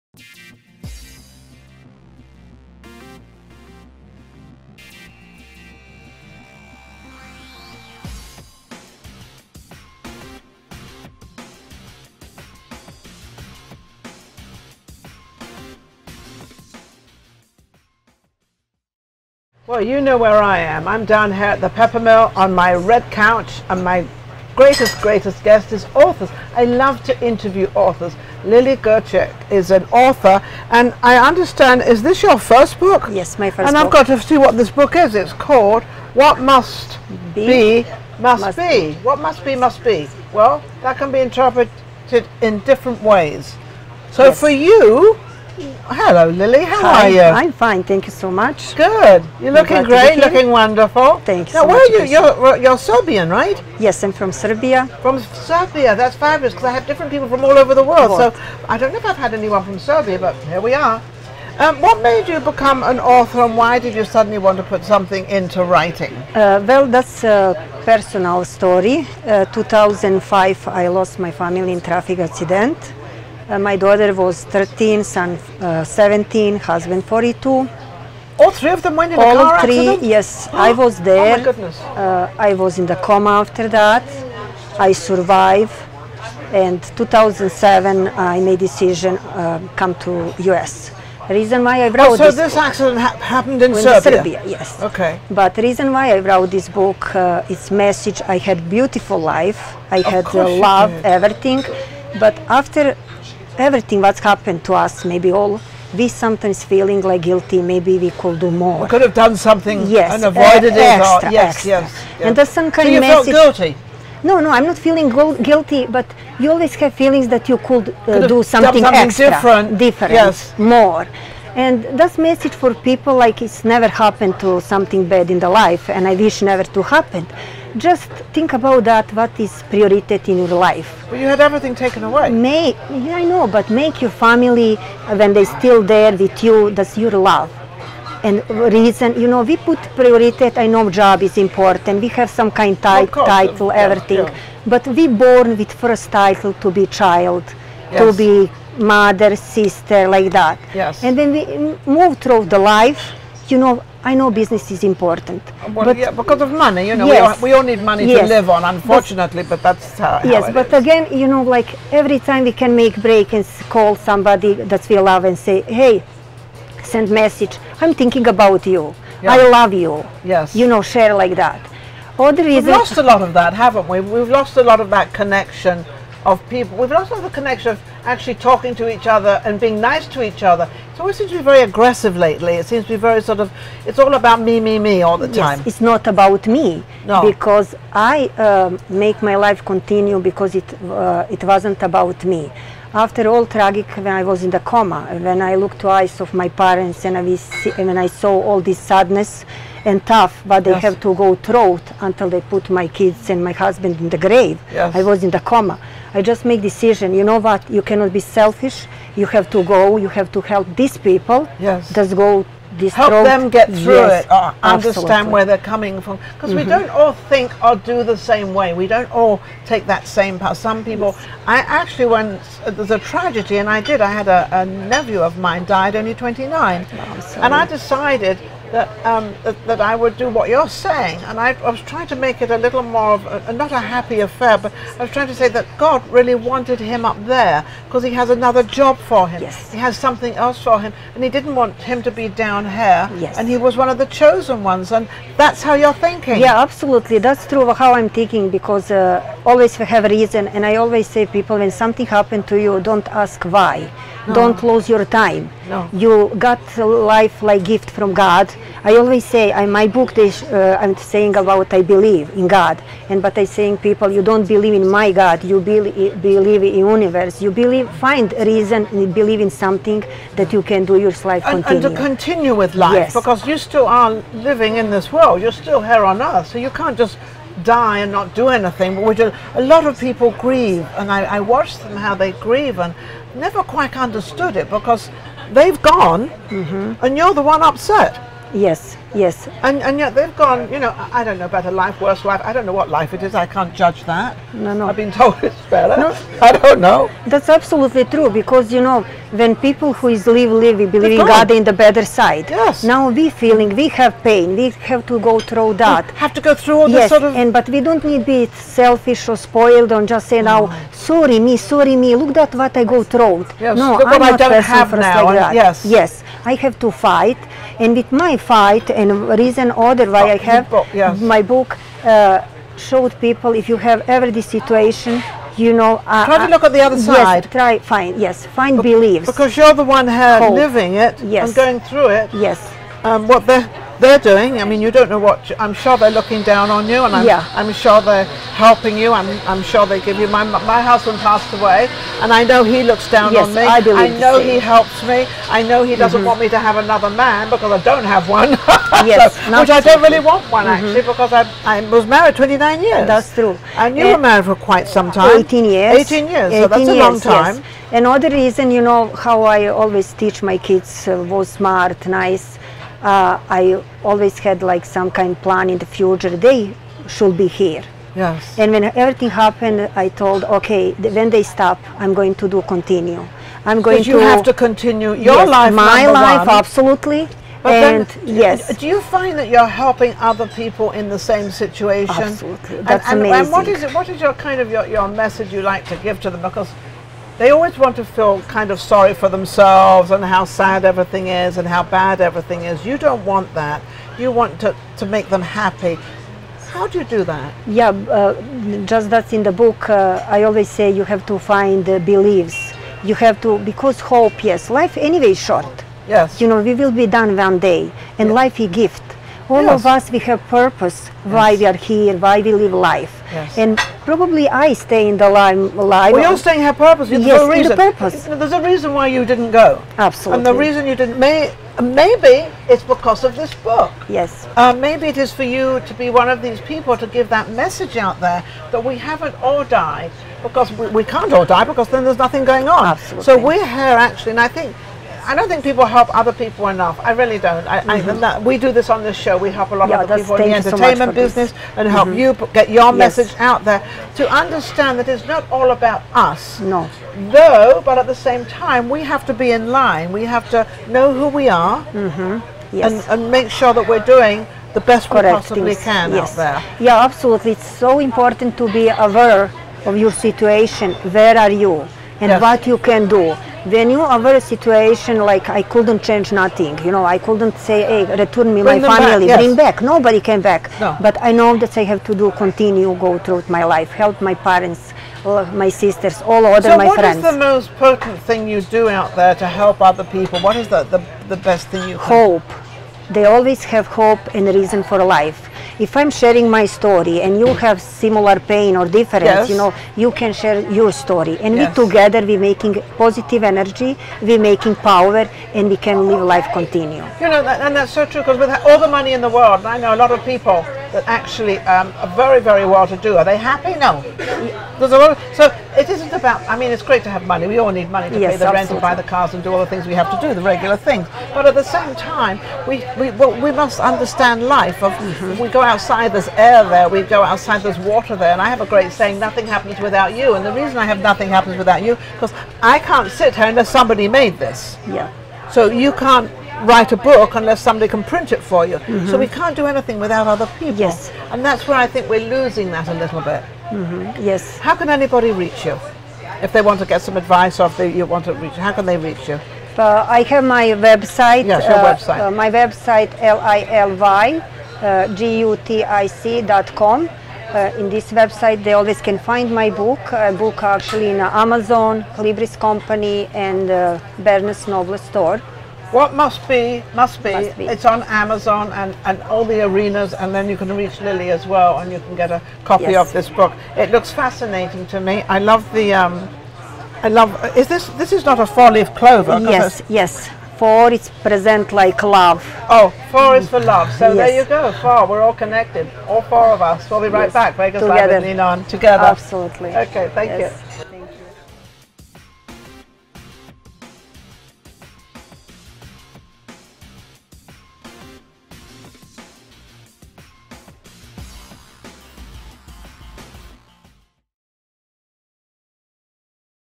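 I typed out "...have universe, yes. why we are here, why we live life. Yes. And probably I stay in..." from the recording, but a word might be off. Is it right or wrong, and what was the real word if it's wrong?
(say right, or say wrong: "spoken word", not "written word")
wrong: "purpose", not "universe".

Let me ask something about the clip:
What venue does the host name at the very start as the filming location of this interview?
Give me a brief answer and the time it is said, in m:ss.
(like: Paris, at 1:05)
Peppermill, at 0:21.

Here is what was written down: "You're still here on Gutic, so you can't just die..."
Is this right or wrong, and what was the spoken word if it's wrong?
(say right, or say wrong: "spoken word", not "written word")
wrong: "Earth", not "Gutic".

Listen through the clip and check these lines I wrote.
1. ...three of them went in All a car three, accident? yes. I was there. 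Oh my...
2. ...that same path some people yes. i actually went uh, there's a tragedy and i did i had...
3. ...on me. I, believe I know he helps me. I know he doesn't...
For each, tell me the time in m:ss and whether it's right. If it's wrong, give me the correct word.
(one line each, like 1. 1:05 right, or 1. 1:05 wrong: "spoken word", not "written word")
1. 1:18 right
2. 3:39 right
3. 5:43 right.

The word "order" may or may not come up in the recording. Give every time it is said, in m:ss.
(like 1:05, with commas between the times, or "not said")
5:19.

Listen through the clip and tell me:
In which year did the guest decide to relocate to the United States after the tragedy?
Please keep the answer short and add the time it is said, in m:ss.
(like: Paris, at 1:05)
2007, at 1:26.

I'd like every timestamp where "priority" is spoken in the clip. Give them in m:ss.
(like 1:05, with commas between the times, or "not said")
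2:09, 2:19.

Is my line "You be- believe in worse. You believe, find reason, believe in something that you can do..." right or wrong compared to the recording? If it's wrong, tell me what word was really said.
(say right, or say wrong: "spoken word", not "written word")
wrong: "universe", not "worse".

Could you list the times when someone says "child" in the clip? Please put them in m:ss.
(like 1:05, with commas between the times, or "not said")
2:26.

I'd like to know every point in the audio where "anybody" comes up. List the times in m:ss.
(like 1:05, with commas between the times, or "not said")
8:54.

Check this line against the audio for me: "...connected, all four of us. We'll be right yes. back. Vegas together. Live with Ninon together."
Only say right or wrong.
right.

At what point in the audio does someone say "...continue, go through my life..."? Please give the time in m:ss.
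7:52.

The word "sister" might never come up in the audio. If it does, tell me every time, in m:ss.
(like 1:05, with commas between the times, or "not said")
2:29, 7:55.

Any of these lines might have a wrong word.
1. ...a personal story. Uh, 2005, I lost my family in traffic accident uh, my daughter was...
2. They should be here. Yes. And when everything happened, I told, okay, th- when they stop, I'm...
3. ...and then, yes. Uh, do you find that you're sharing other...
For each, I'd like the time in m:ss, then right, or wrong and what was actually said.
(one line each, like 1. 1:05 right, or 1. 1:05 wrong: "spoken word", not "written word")
1. 1:07 right
2. 6:06 right
3. 6:17 wrong: "helping", not "sharing".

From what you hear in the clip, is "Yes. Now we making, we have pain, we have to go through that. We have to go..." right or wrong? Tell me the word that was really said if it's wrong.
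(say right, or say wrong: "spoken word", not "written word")
wrong: "feeling", not "making".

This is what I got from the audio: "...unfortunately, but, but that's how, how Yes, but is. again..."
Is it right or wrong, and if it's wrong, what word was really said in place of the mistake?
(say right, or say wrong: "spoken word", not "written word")
right.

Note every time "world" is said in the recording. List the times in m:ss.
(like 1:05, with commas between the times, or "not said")
0:57, 4:35, 8:19.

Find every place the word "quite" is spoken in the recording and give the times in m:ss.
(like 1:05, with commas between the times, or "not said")
4:43, 5:54.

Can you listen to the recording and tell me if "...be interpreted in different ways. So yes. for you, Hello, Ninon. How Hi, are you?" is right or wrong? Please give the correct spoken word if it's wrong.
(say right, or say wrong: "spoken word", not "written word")
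wrong: "Lily", not "Ninon".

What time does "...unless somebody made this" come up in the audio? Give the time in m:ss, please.
8:43.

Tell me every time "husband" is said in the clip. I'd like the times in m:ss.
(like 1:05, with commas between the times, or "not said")
1:16, 3:23, 5:40.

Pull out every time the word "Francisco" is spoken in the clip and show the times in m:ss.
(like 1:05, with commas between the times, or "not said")
not said.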